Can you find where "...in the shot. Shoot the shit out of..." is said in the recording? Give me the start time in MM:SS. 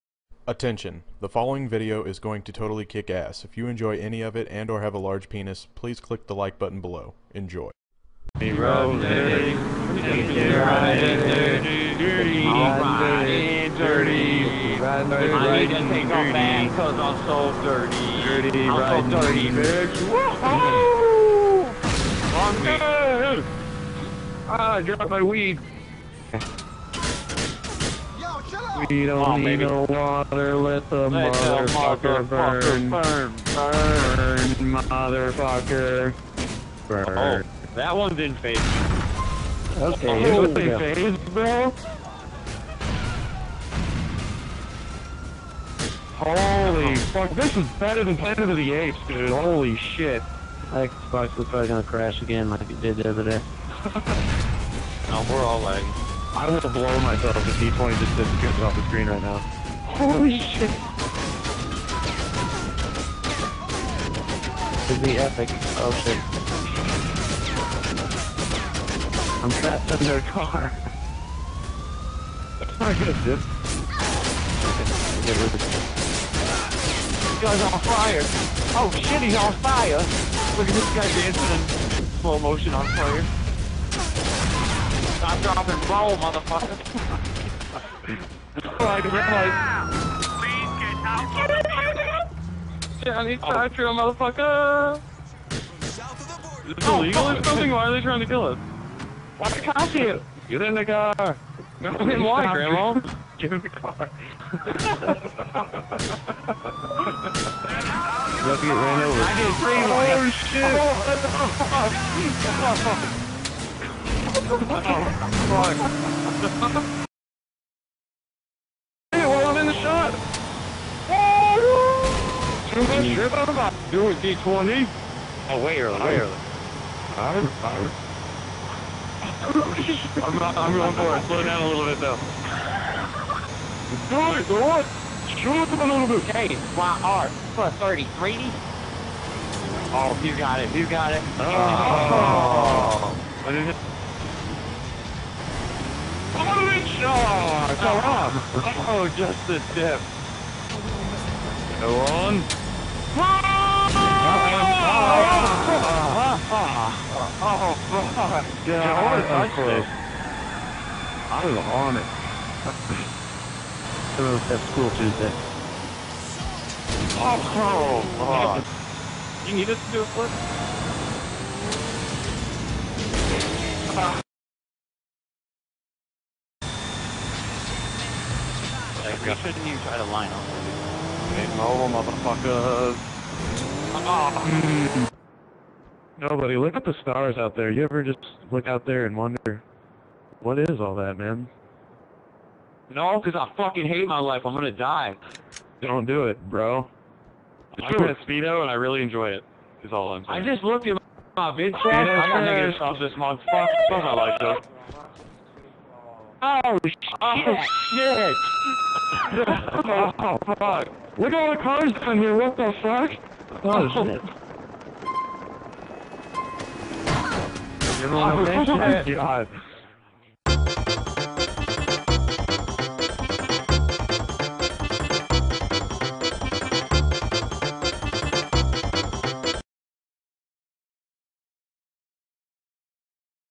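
01:59.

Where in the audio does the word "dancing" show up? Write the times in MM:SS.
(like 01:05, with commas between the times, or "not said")
01:21.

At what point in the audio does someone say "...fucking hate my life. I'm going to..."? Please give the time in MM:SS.
03:13.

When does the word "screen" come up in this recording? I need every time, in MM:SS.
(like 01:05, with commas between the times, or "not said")
00:58.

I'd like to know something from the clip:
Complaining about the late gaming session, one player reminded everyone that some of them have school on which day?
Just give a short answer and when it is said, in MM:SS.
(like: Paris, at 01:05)
Tuesday, at 02:44.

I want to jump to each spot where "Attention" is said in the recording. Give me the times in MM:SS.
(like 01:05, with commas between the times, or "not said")
00:00.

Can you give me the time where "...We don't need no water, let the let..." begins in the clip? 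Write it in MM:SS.
00:28.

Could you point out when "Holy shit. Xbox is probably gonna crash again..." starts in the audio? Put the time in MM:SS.
00:49.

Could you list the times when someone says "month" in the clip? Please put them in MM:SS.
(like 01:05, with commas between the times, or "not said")
03:23.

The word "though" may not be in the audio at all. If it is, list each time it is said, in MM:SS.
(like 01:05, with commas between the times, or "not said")
02:11, 03:24.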